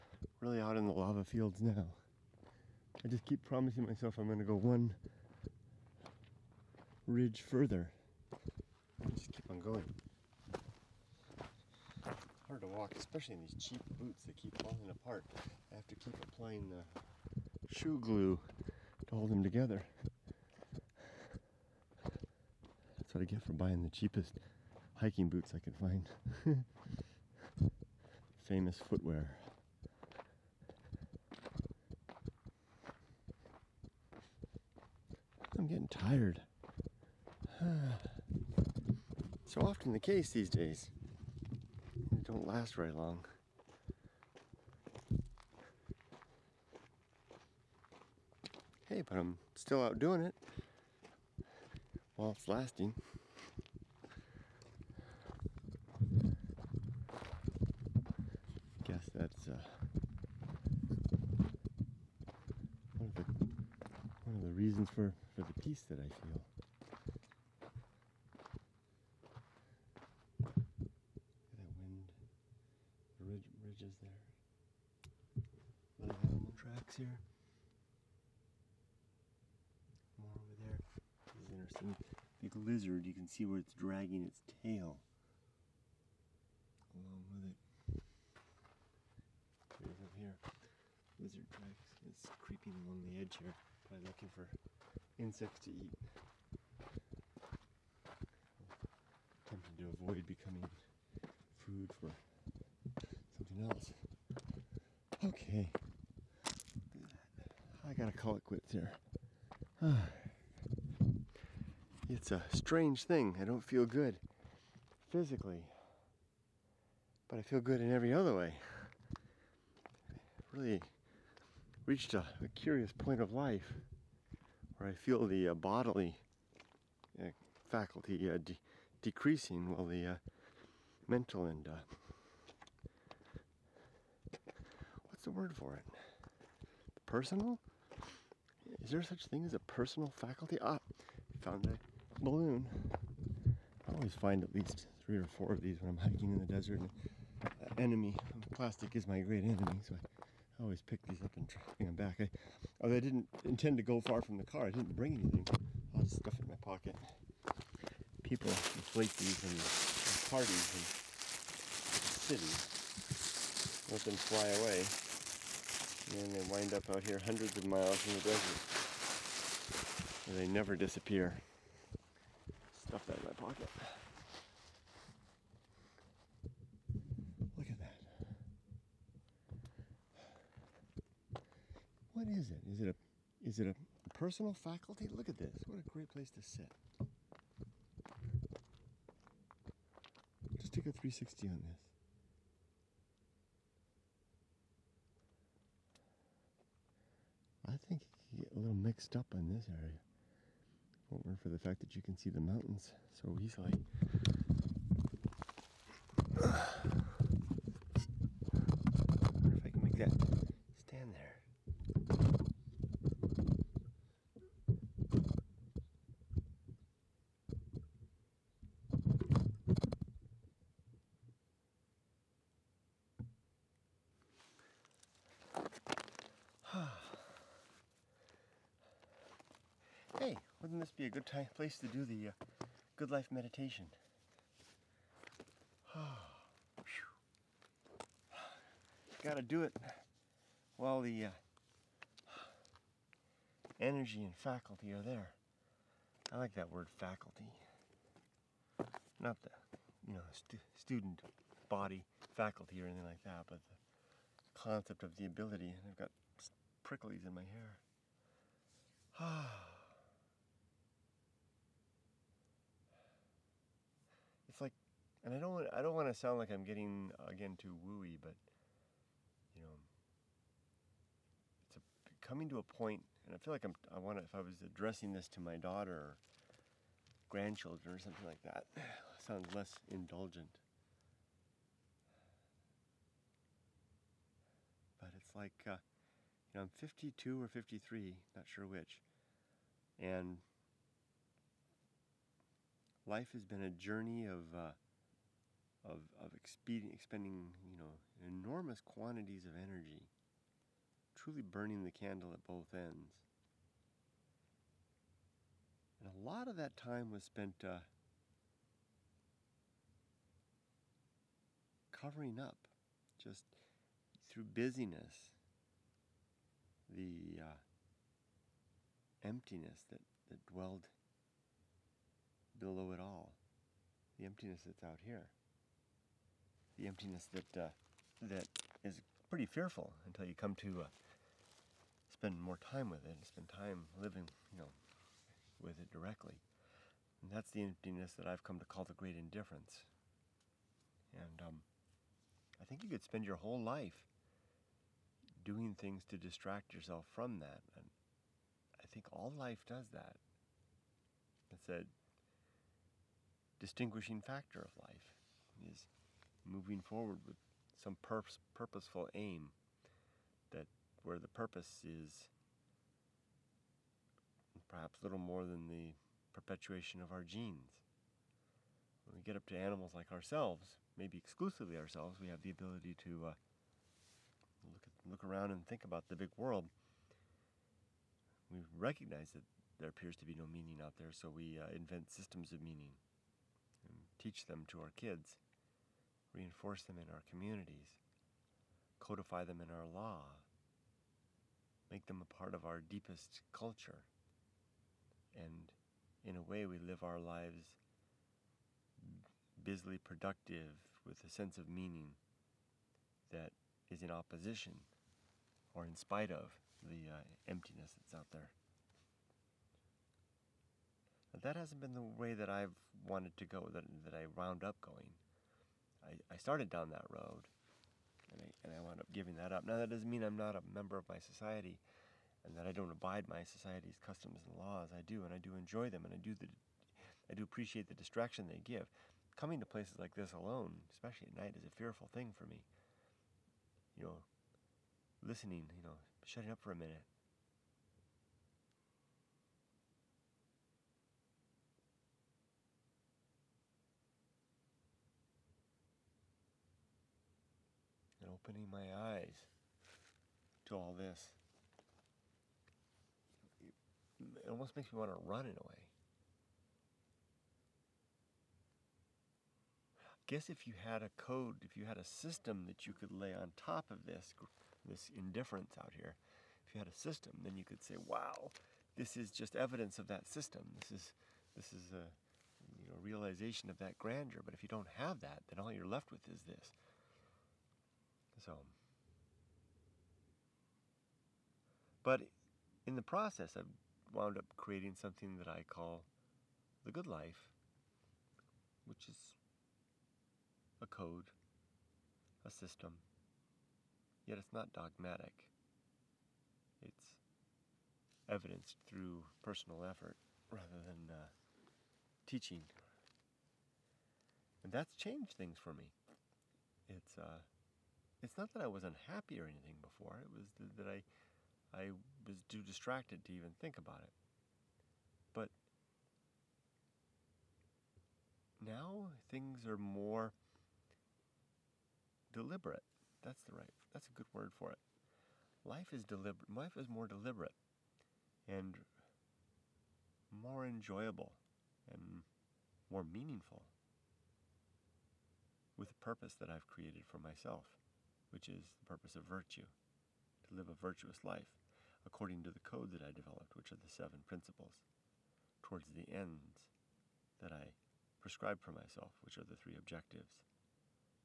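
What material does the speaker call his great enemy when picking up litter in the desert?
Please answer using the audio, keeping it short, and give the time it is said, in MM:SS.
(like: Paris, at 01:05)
Plastic, at 02:28.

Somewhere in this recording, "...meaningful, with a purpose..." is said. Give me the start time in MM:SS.
08:53.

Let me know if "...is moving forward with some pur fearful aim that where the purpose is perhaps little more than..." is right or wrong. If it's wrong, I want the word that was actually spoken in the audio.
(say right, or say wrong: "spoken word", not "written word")
wrong: "purposeful", not "fearful".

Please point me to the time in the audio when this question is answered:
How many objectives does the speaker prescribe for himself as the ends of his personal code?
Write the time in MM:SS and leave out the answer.
09:09.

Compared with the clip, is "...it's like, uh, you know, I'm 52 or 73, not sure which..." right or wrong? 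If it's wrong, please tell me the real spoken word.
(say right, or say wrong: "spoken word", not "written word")
wrong: "53", not "73".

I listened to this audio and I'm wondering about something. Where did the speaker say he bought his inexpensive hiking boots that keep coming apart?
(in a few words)
Famous Footwear.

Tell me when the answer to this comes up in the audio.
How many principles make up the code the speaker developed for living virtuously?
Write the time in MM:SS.
09:03.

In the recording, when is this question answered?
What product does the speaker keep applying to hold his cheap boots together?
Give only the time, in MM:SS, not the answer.
00:17.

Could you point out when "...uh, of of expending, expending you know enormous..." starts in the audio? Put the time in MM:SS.
04:54.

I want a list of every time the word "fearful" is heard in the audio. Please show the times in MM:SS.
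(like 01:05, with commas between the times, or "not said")
05:29, 07:11.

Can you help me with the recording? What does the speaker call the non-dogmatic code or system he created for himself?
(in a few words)
The good life.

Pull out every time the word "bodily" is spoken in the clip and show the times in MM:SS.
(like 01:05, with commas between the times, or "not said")
02:05.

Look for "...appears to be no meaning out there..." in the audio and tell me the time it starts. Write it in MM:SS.
06:19.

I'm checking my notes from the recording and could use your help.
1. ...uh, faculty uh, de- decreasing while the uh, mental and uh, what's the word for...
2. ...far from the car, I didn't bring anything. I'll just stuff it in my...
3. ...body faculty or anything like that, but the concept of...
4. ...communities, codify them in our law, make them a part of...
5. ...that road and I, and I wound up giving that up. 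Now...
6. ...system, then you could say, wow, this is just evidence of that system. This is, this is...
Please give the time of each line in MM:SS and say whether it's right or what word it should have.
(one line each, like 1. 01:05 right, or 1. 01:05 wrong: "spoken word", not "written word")
1. 02:07 right
2. 02:33 right
3. 04:11 right
4. 06:27 right
5. 06:56 right
6. 07:46 right.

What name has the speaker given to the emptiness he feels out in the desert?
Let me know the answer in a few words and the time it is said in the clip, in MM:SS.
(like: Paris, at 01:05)
The great indifference, at 05:38.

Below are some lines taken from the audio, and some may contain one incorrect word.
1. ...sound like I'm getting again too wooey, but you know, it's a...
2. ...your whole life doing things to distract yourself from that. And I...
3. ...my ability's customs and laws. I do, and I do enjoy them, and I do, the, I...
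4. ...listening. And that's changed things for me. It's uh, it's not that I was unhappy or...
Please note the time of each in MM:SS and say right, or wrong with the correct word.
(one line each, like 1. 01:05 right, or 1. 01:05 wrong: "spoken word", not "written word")
1. 04:26 right
2. 05:43 right
3. 07:03 wrong: "society", not "ability"
4. 08:22 wrong: "teaching", not "listening".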